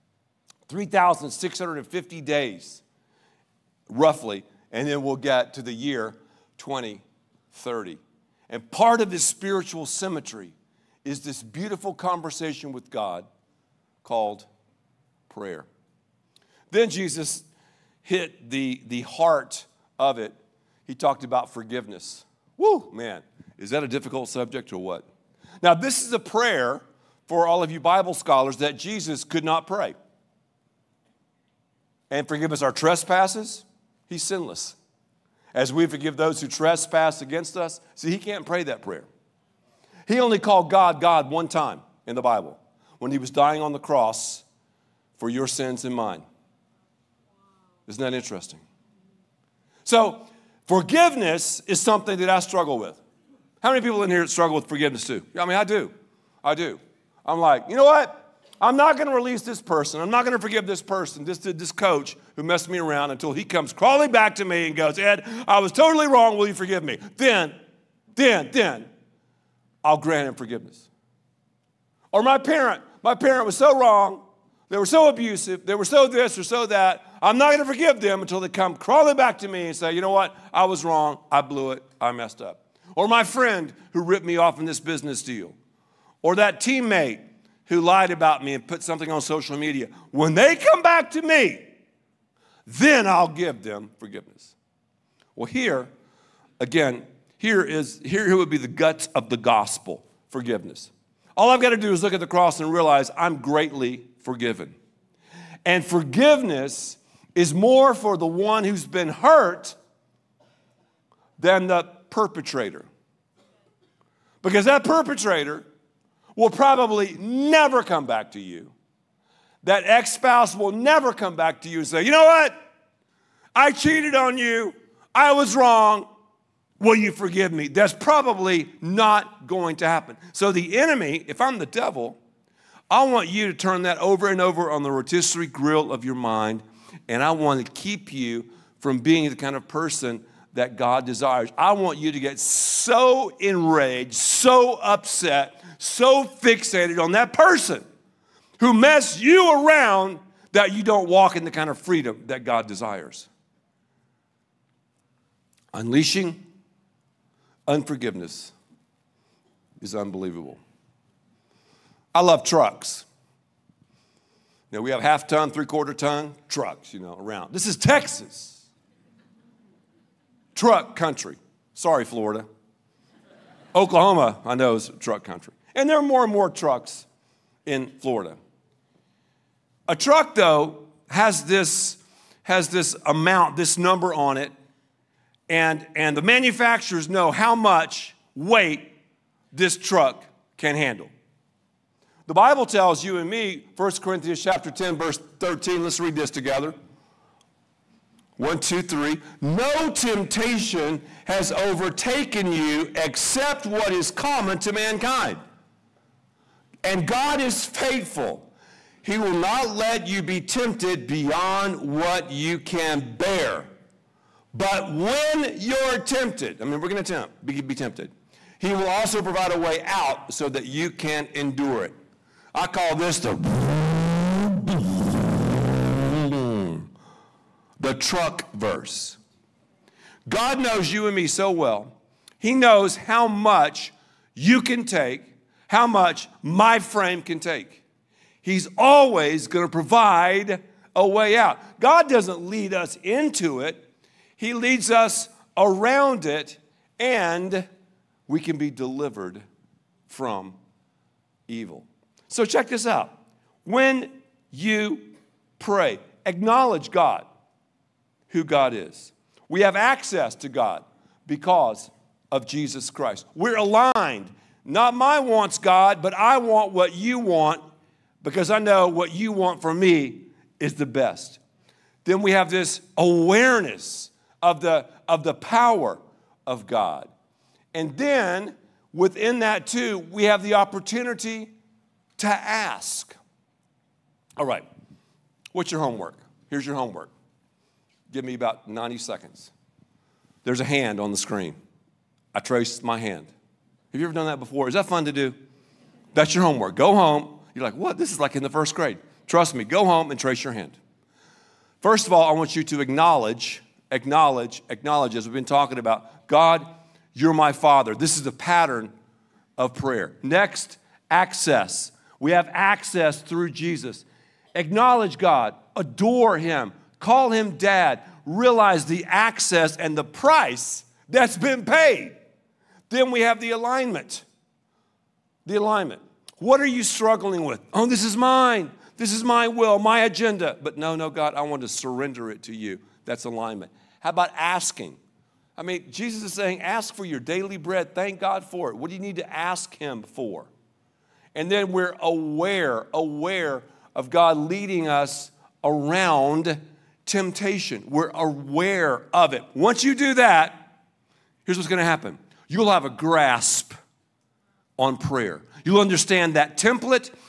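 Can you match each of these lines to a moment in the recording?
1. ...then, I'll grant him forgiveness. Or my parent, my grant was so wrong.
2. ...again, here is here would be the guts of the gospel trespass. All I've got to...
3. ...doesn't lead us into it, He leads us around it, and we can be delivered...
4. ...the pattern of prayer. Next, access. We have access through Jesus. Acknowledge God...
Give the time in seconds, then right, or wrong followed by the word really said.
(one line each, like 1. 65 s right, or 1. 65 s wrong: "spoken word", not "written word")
1. 68 s wrong: "parent", not "grant"
2. 96 s wrong: "forgiveness", not "trespass"
3. 242 s right
4. 308 s right.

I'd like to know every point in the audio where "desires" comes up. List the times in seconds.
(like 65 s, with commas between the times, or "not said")
141 s, 152 s.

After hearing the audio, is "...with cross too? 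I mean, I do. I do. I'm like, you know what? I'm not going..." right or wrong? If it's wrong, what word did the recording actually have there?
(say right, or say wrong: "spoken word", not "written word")
wrong: "forgiveness", not "cross".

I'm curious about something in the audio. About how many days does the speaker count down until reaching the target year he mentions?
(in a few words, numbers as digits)
3,650.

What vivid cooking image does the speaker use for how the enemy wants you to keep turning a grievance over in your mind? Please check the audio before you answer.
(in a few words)
rotisserie grill.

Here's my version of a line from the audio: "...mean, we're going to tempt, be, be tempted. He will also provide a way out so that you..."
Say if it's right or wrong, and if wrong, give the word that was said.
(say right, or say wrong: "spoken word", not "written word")
right.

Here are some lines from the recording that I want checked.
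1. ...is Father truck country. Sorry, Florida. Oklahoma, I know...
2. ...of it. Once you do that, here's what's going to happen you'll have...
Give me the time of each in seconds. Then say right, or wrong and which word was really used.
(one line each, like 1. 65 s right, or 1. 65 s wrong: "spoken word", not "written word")
1. 167 s wrong: "Texas", not "Father"
2. 349 s right.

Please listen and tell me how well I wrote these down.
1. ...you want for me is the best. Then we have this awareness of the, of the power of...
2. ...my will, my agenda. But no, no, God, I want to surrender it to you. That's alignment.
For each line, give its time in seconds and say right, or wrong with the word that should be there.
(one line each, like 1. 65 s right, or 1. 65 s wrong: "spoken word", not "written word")
1. 269 s right
2. 329 s right.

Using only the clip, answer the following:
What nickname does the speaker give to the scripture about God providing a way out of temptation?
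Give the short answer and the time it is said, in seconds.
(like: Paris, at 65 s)
the truck verse, at 227 s.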